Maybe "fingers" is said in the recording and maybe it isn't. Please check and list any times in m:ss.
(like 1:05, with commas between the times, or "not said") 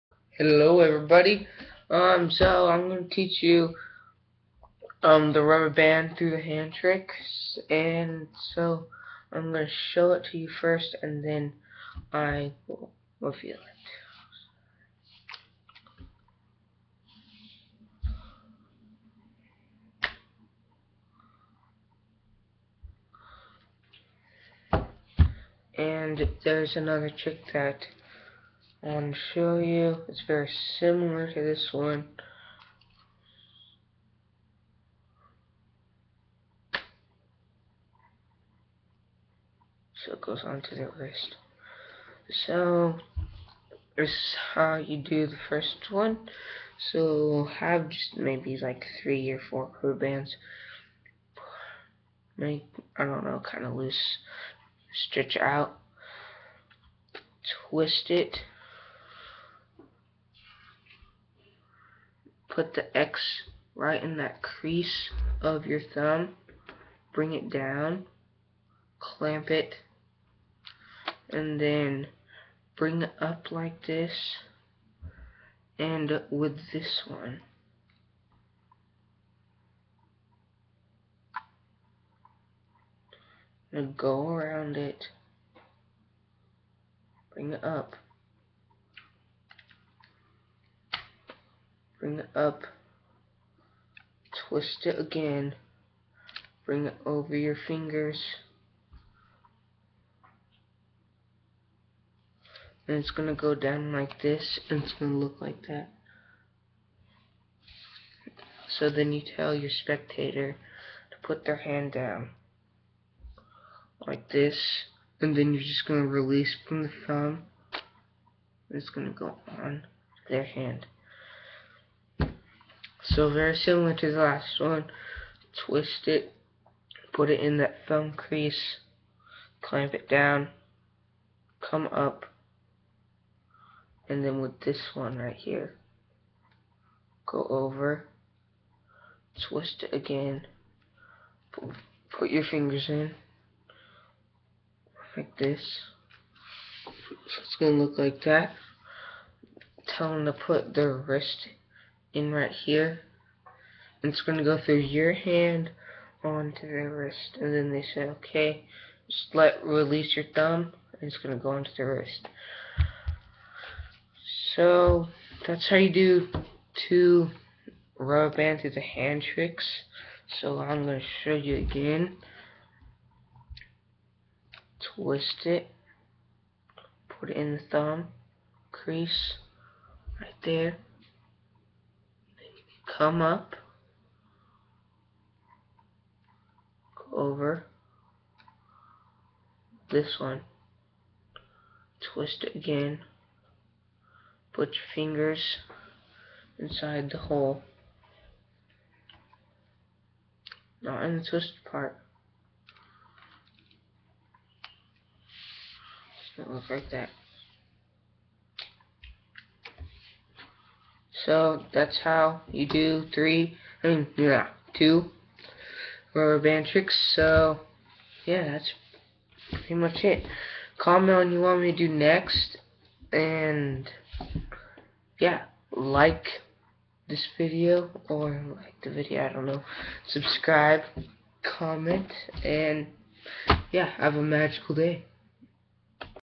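1:37, 2:22, 3:14.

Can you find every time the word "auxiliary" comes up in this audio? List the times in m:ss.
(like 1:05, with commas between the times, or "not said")
not said.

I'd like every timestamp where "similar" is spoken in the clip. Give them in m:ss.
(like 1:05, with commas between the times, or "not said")
0:30, 2:03.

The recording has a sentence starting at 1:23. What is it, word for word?
go around it, bring it up.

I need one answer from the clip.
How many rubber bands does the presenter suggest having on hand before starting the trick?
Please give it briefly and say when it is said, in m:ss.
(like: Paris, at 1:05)
3 or 4, at 0:49.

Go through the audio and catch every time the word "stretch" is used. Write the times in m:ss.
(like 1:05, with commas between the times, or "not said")
0:54.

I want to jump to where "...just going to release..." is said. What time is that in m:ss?
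1:55.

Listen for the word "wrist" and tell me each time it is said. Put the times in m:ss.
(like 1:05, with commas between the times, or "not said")
0:40, 2:30, 2:36, 2:41.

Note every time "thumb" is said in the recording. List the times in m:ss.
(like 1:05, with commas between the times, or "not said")
1:05, 1:57, 2:07, 2:40, 2:57.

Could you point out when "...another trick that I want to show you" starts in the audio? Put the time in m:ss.
0:26.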